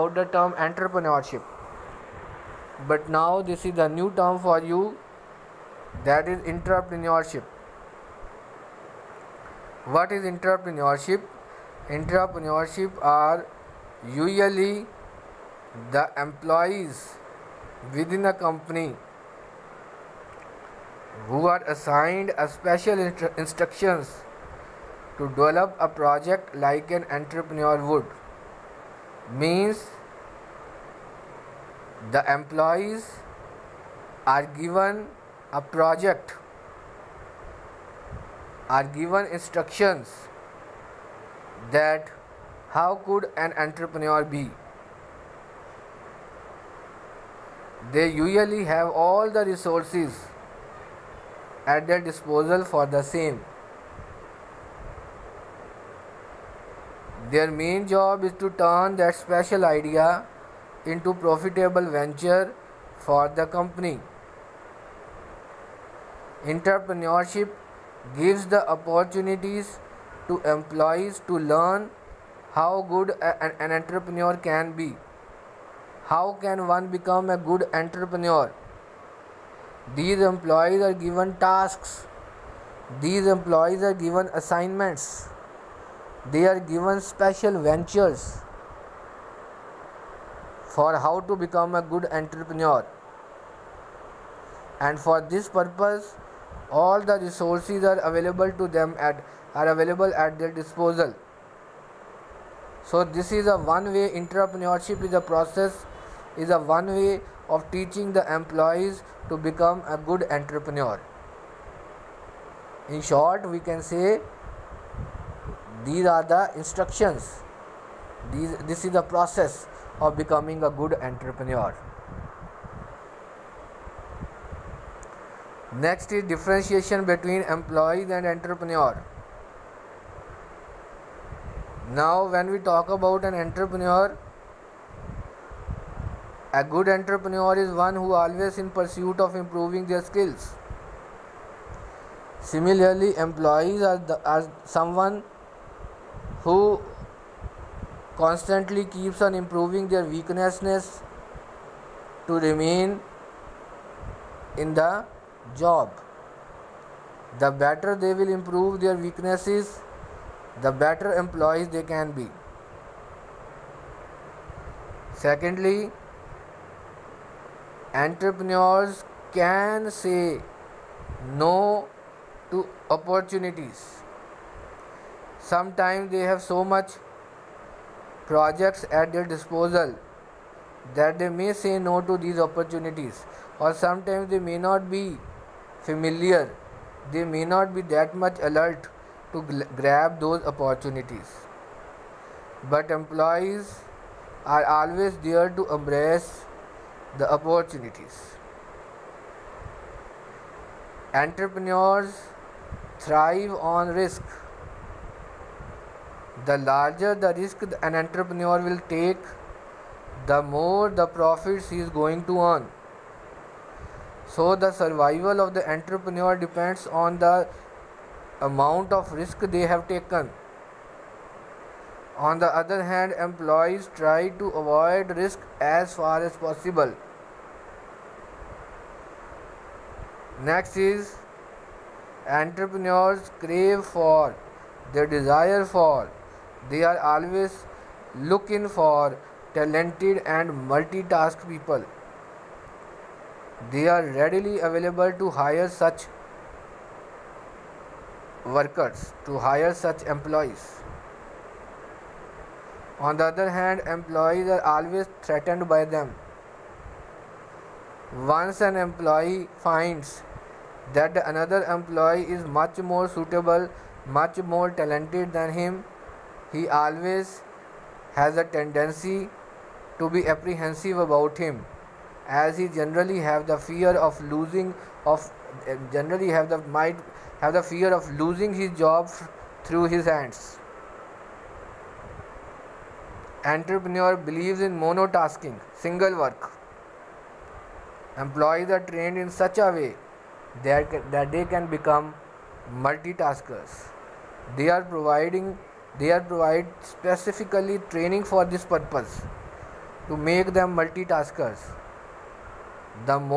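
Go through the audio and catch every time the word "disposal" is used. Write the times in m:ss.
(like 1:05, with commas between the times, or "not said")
0:51, 1:40, 2:59.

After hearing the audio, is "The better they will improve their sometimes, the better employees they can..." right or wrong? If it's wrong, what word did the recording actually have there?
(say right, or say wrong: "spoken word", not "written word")
wrong: "weaknesses", not "sometimes".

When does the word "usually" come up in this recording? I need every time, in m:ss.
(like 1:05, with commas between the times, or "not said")
0:14, 0:48.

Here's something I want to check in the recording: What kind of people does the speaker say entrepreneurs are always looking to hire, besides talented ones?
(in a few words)
Multitask people.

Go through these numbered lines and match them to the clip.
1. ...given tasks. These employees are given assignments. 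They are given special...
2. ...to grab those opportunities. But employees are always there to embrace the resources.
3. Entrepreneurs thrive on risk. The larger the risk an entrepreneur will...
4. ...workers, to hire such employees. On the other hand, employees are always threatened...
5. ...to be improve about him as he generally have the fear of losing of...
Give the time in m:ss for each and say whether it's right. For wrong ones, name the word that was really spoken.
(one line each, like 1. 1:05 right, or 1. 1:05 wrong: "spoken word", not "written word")
1. 1:20 right
2. 3:09 wrong: "opportunities", not "resources"
3. 3:21 right
4. 4:08 right
5. 4:29 wrong: "apprehensive", not "improve".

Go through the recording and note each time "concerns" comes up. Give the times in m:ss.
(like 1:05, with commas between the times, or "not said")
not said.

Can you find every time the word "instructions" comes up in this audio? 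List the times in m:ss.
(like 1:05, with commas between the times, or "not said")
0:23, 0:39, 1:56.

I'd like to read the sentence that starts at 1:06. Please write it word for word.
Intrapreneurship gives the opportunities to employees to learn how good a, an entrepreneur can be.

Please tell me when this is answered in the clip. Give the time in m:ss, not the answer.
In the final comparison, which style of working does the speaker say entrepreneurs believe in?
4:44.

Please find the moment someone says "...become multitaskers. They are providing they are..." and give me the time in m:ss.
4:51.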